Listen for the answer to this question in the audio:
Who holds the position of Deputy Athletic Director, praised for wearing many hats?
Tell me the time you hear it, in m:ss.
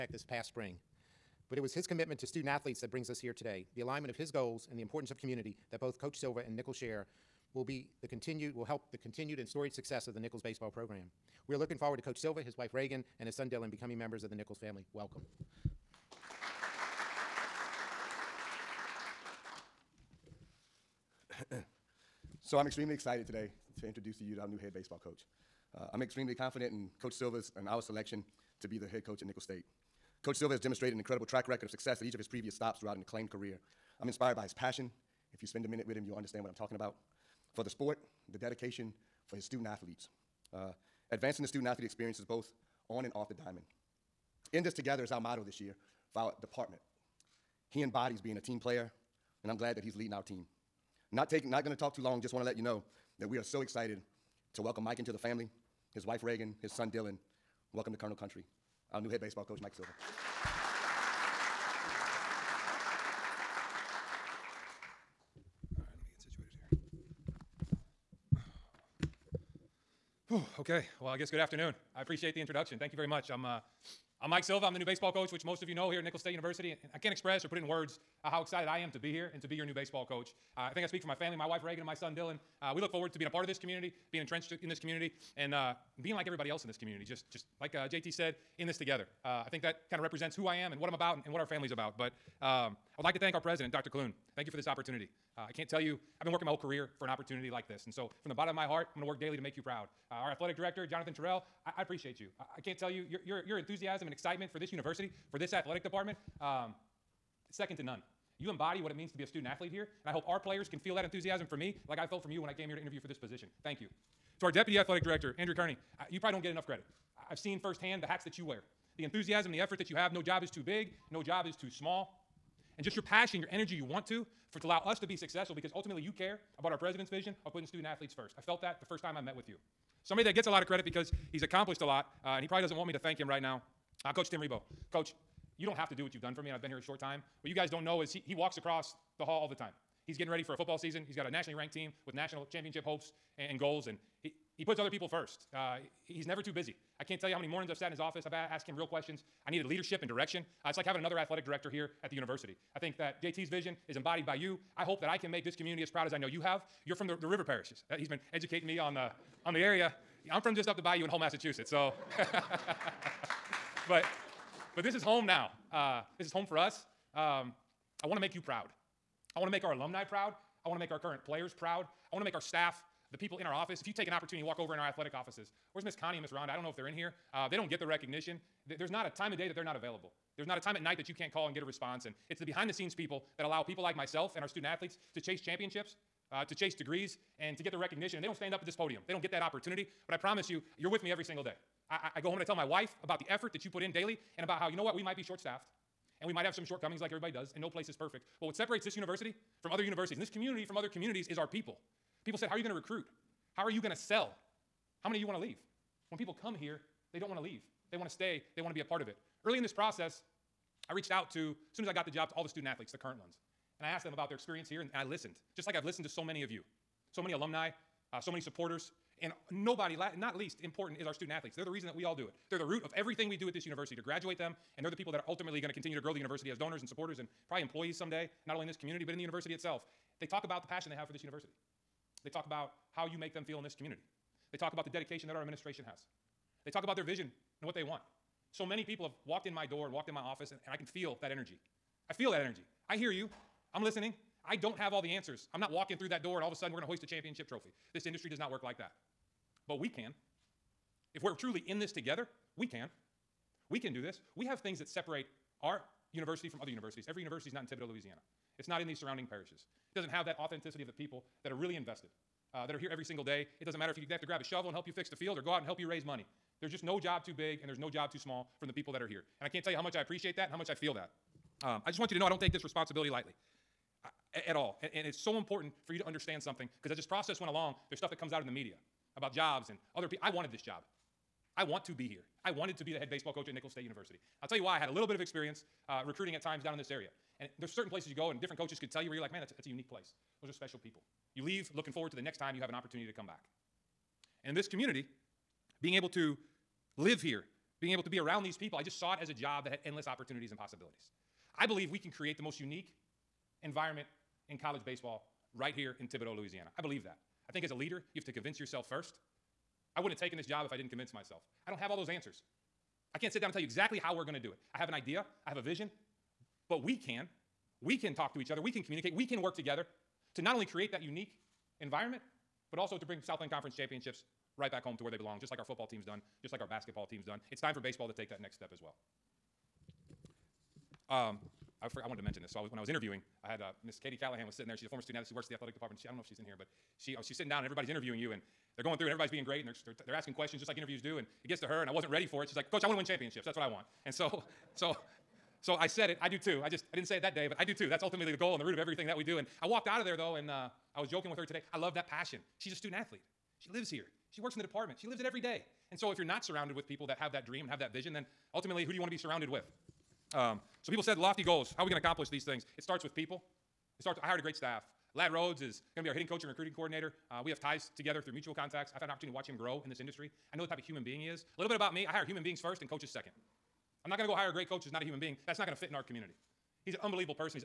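1:55.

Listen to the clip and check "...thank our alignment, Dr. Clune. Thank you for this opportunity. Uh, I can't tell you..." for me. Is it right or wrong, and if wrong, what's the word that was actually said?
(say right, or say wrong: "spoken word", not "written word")
wrong: "president", not "alignment".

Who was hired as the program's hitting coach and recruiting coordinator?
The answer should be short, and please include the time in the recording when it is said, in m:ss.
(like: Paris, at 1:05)
Lad Rhodes, at 6:05.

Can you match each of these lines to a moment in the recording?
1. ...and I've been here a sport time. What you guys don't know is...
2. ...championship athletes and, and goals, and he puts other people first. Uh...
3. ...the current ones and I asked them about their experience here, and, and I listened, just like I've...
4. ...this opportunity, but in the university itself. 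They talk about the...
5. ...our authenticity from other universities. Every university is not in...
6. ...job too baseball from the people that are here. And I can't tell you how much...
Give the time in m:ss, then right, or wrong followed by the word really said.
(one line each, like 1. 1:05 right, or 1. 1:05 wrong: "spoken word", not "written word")
1. 2:16 wrong: "short", not "sport"
2. 2:22 wrong: "hopes", not "athletes"
3. 3:32 right
4. 3:48 wrong: "community", not "opportunity"
5. 4:15 wrong: "university", not "authenticity"
6. 4:27 wrong: "small", not "baseball".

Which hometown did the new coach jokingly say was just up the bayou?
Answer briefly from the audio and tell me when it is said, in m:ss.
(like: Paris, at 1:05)
Hull, Massachusetts, at 2:41.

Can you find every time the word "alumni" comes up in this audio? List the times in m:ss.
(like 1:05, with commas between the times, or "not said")
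2:49, 3:37.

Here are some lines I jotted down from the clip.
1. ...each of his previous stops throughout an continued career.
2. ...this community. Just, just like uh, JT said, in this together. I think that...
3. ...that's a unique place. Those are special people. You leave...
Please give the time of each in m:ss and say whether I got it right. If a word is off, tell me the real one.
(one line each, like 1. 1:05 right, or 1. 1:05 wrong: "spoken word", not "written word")
1. 0:32 wrong: "acclaimed", not "continued"
2. 1:26 right
3. 4:49 right.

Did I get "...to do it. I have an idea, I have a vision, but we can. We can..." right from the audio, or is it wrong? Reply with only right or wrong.
right.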